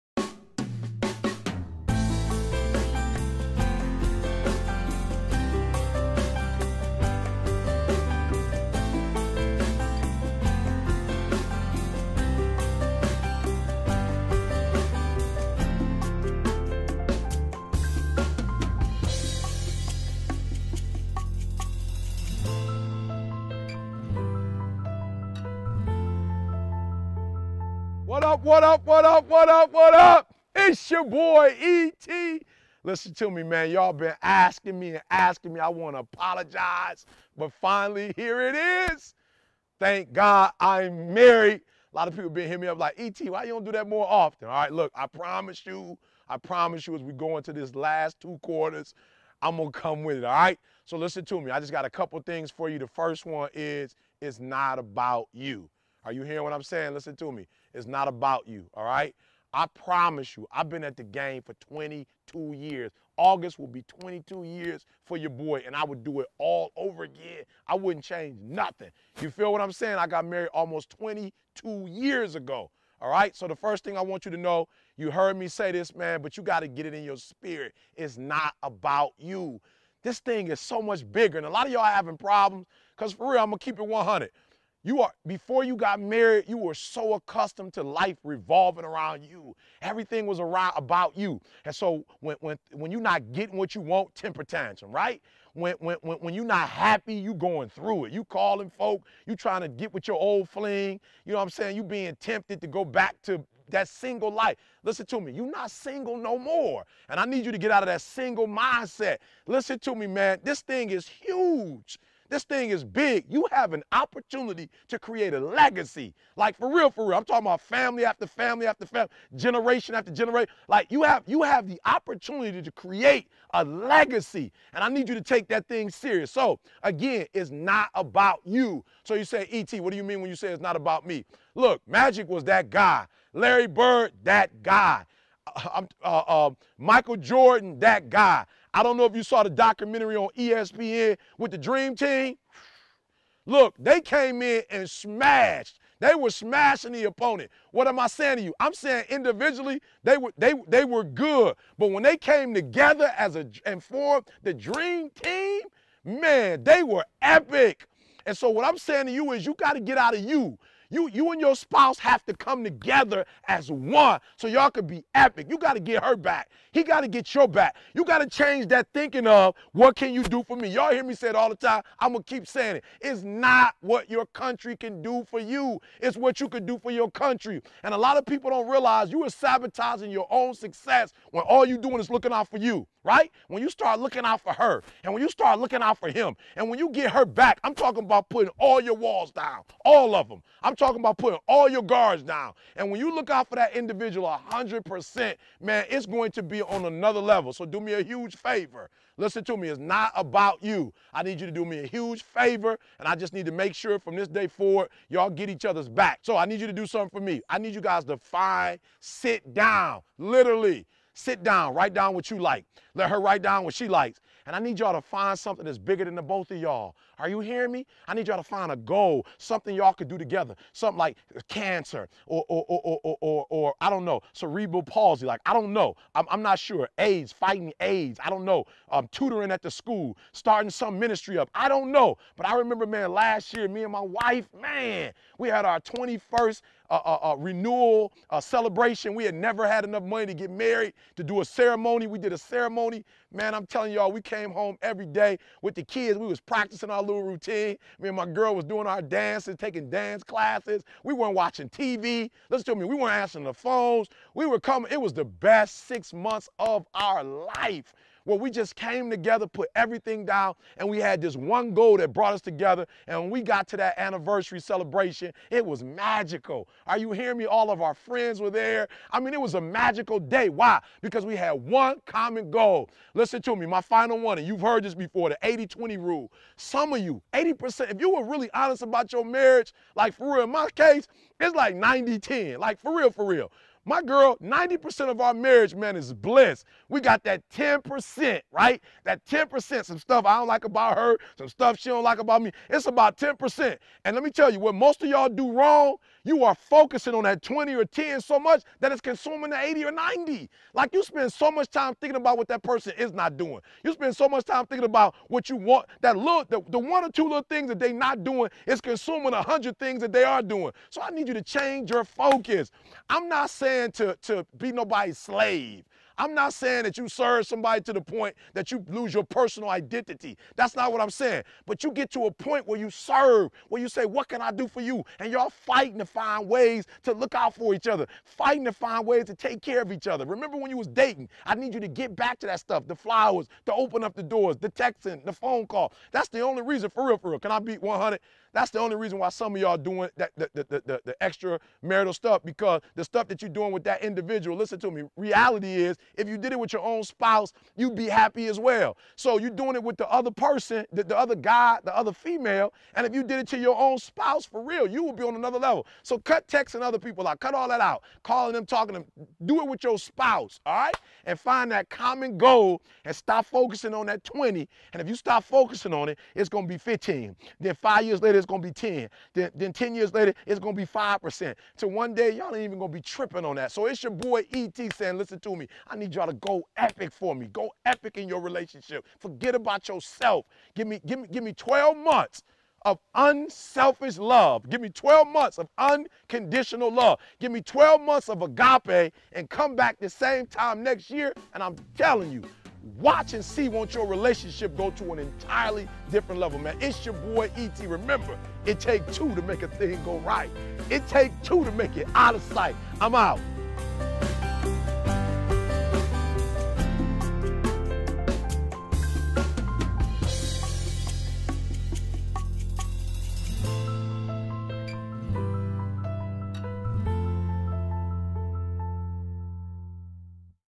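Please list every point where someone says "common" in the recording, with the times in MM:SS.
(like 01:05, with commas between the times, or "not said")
04:32, 06:01.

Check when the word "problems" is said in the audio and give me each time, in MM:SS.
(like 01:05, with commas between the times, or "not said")
01:22.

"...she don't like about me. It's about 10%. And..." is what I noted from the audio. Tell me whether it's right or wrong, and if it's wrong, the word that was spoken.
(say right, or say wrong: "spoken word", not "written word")
right.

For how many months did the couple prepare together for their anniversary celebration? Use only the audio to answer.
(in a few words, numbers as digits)
6.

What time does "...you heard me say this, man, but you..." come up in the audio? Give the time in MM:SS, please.
01:14.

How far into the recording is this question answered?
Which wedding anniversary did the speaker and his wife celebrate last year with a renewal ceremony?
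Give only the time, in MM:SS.
03:55.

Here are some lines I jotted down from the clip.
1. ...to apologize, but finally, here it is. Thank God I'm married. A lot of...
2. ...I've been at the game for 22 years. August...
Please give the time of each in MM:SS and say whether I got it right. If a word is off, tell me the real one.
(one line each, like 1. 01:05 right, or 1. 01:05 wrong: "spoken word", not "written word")
1. 00:35 right
2. 01:00 right.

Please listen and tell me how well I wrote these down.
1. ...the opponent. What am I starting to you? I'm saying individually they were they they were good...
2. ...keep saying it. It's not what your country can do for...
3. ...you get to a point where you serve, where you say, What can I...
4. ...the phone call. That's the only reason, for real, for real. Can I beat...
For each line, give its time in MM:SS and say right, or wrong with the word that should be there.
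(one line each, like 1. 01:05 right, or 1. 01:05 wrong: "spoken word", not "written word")
1. 02:26 wrong: "saying", not "starting"
2. 02:52 right
3. 05:21 right
4. 05:35 right.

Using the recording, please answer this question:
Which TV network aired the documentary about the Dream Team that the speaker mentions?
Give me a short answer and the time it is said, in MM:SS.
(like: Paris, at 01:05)
ESPN, at 02:20.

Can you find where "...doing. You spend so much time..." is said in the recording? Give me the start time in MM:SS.
05:03.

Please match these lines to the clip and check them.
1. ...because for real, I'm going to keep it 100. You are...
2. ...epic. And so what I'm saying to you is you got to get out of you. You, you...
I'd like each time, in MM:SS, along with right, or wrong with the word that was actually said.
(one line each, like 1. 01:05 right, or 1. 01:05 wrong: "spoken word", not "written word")
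1. 01:22 right
2. 02:37 right.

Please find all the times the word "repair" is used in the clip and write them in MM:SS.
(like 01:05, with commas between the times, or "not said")
not said.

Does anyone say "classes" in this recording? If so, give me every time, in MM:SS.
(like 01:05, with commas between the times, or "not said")
04:10.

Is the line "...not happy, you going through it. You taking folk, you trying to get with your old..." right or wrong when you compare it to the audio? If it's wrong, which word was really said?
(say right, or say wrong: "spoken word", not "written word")
wrong: "calling", not "taking".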